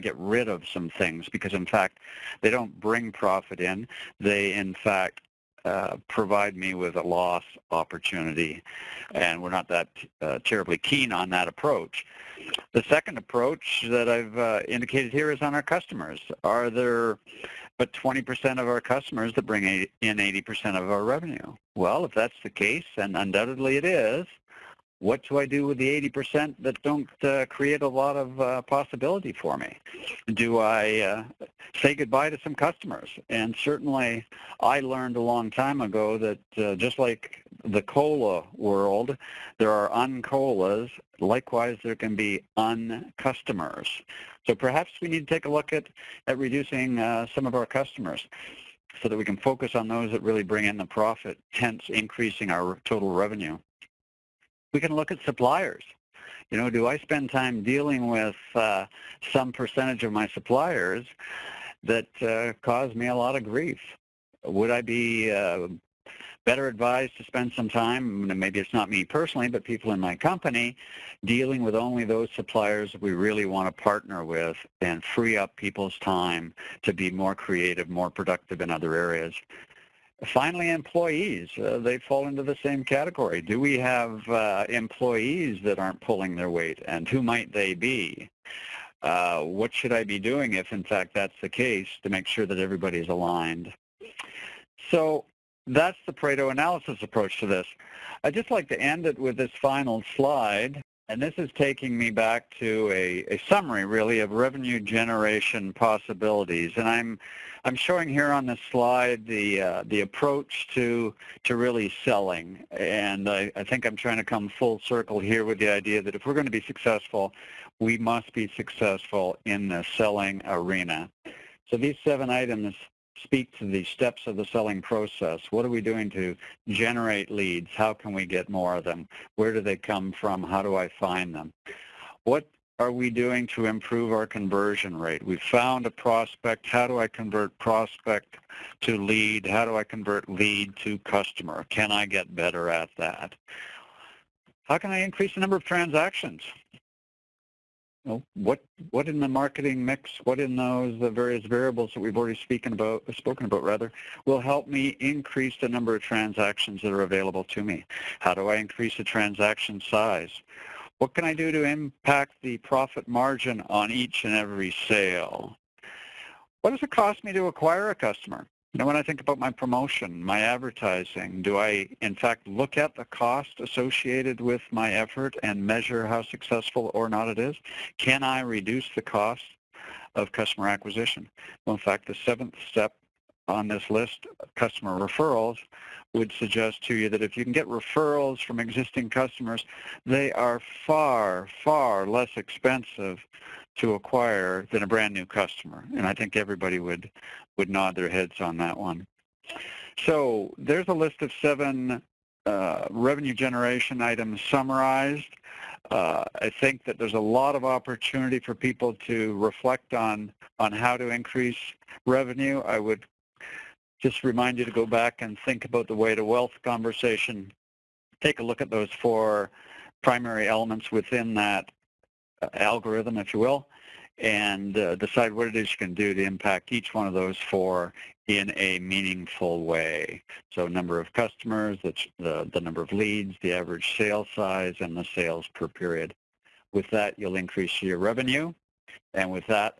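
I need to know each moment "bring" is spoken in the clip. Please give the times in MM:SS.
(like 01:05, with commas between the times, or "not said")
00:02, 00:19, 00:50.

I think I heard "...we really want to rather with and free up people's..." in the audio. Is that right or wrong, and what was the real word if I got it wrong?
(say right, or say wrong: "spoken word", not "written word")
wrong: "partner", not "rather".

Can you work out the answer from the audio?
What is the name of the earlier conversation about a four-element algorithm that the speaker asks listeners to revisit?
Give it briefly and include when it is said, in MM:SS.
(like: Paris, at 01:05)
The way to wealth, at 03:35.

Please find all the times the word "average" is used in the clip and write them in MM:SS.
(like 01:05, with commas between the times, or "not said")
03:53.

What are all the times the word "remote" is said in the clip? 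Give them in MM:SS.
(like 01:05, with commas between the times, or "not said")
not said.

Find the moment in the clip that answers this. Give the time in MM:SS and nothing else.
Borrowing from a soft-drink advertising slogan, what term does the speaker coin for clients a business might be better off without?
00:42.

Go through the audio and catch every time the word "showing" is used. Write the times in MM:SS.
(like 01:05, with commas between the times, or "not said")
01:47.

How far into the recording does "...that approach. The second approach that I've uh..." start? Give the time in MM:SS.
00:11.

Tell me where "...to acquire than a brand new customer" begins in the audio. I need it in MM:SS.
03:13.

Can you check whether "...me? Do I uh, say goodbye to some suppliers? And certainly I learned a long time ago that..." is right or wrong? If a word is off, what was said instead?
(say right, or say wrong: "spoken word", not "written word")
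wrong: "customers", not "suppliers".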